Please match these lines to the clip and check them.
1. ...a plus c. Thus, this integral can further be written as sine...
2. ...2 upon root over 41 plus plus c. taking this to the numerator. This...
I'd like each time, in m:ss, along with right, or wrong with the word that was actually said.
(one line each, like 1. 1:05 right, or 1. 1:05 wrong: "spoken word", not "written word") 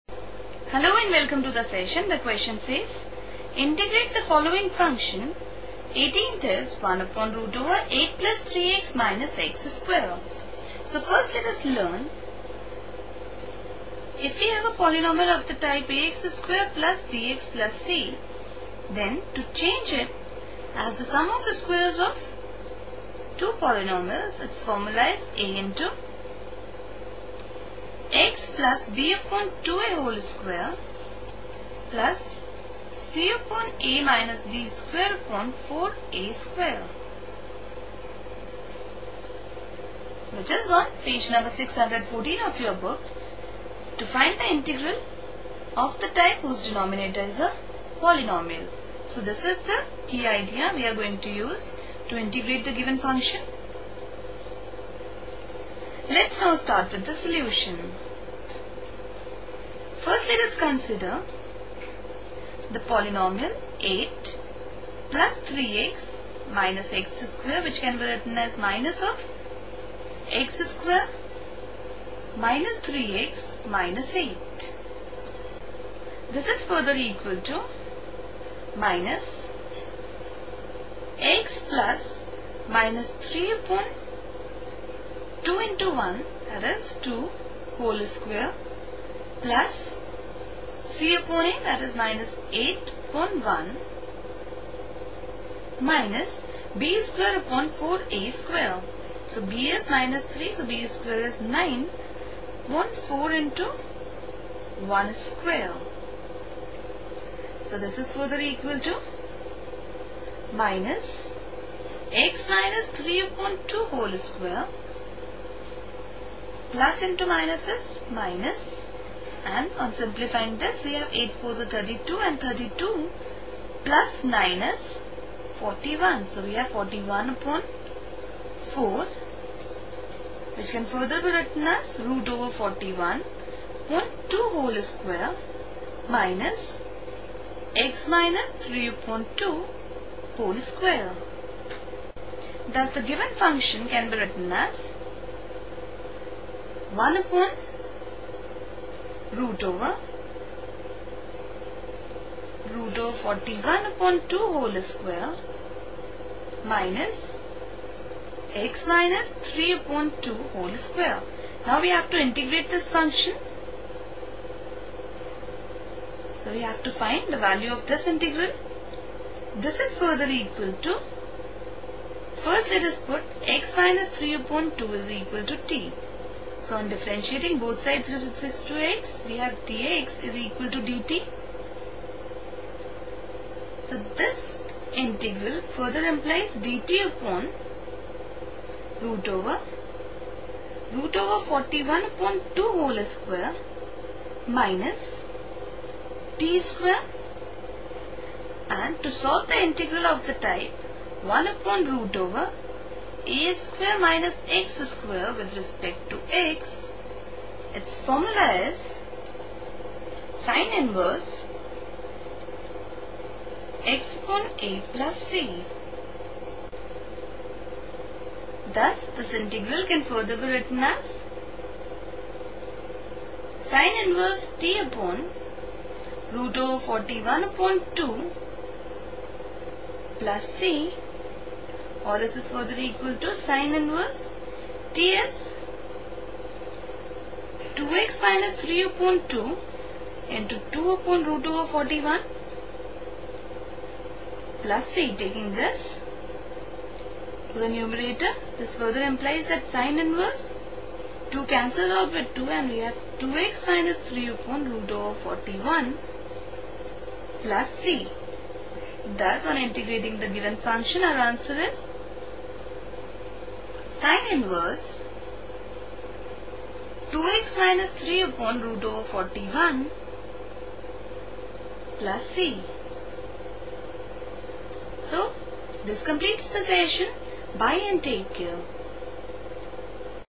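1. 3:34 right
2. 4:00 right.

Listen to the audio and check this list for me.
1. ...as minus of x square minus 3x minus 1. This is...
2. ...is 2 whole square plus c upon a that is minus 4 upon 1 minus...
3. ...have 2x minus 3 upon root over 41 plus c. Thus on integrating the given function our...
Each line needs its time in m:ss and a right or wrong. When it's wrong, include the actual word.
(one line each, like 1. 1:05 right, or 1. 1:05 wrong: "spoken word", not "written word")
1. 1:08 wrong: "8", not "1"
2. 1:26 wrong: "8", not "4"
3. 4:12 right.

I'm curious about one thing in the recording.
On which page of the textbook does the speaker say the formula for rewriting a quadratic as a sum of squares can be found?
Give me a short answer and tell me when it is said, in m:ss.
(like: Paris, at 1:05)
614, at 0:41.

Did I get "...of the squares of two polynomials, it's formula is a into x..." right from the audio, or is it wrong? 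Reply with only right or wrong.
right.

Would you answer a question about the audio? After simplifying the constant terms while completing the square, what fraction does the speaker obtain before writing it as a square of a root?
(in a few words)
41/4.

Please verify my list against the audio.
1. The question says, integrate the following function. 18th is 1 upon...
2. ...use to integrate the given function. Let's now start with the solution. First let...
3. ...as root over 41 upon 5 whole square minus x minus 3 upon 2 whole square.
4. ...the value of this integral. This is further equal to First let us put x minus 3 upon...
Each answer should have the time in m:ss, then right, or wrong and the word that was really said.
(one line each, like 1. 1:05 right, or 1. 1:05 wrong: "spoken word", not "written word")
1. 0:02 right
2. 0:51 right
3. 2:11 wrong: "2", not "5"
4. 2:47 right.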